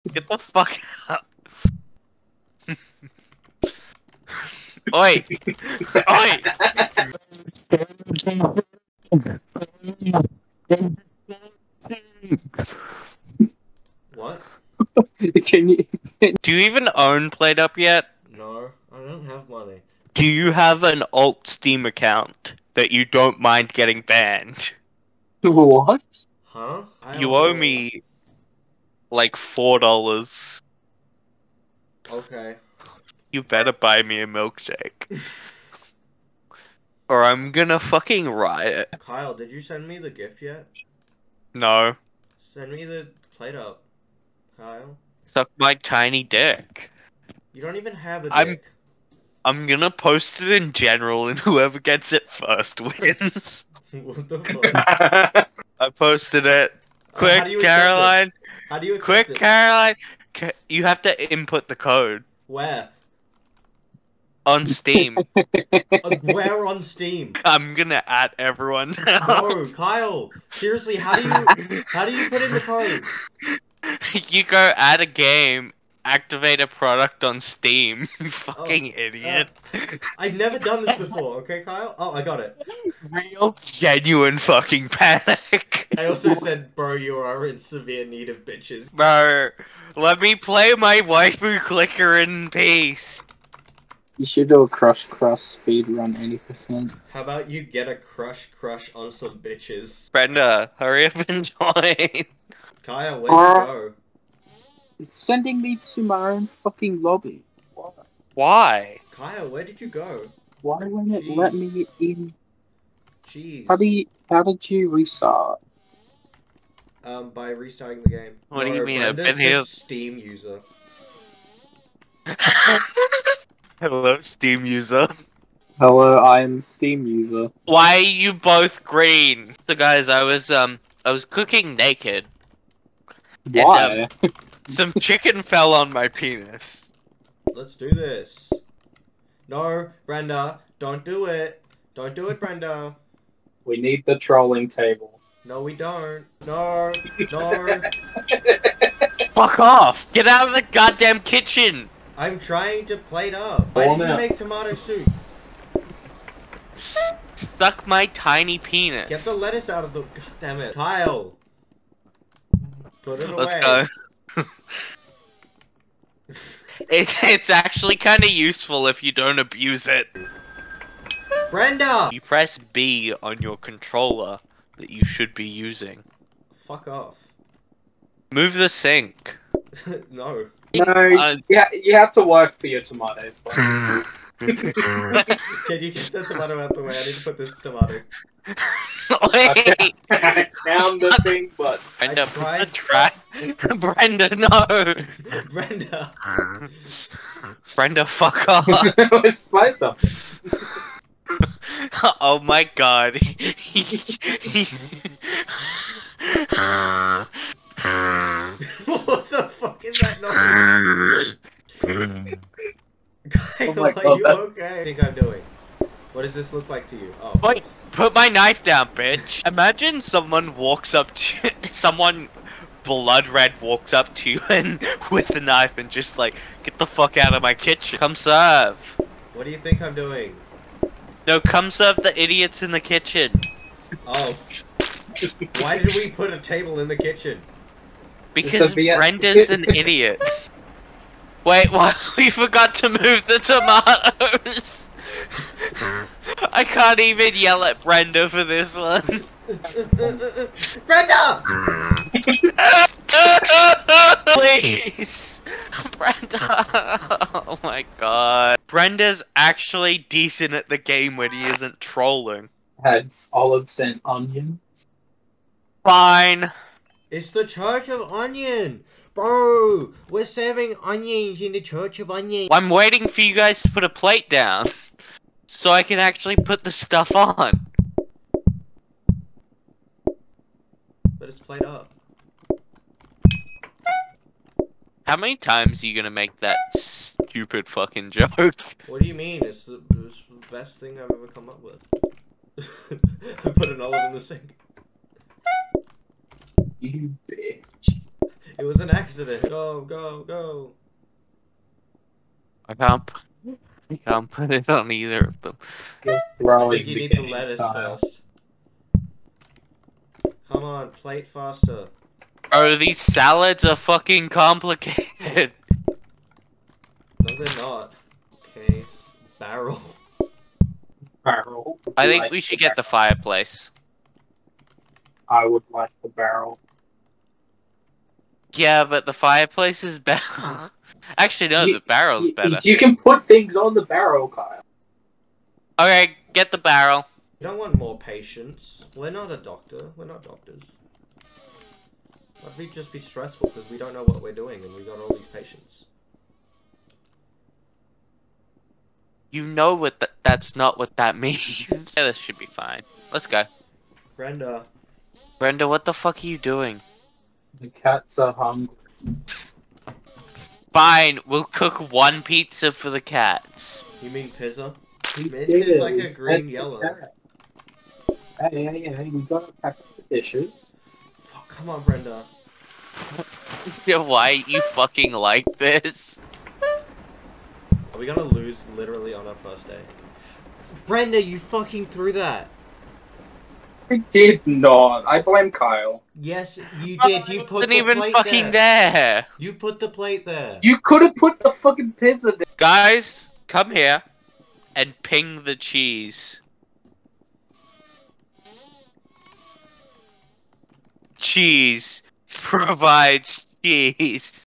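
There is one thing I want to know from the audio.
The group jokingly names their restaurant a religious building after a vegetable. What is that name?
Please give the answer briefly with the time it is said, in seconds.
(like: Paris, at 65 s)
Church of Onion, at 267 s.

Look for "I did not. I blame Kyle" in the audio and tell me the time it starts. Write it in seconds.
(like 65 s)
383 s.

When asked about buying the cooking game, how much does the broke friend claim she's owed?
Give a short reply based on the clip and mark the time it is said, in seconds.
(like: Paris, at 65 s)
$4, at 29 s.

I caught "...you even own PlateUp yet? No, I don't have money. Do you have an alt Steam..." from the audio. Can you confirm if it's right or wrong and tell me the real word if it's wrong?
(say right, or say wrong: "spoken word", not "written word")
right.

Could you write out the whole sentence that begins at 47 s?
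You don't even have a dick.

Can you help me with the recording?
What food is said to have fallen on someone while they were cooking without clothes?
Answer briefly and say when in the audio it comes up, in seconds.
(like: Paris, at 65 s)
Chicken, at 135 s.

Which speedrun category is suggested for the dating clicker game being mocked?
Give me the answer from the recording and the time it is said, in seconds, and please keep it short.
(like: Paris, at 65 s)
80%, at 96 s.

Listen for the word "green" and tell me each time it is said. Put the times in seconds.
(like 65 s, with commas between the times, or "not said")
128 s, 366 s.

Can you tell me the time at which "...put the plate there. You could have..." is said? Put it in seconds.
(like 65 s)
389 s.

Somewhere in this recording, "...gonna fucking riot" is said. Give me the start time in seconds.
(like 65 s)
37 s.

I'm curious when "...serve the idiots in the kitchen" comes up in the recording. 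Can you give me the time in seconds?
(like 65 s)
231 s.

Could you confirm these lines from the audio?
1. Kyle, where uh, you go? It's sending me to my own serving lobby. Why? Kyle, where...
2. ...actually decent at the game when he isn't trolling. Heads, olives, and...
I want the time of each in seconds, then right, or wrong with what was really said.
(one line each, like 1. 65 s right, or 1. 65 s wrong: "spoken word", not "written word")
1. 102 s wrong: "fucking", not "serving"
2. 259 s right.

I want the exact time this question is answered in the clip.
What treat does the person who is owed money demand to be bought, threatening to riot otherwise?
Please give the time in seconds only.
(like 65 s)
34 s.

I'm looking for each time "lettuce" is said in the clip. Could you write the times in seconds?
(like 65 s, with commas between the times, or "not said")
159 s, 307 s.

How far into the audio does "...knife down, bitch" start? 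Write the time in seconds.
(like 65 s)
218 s.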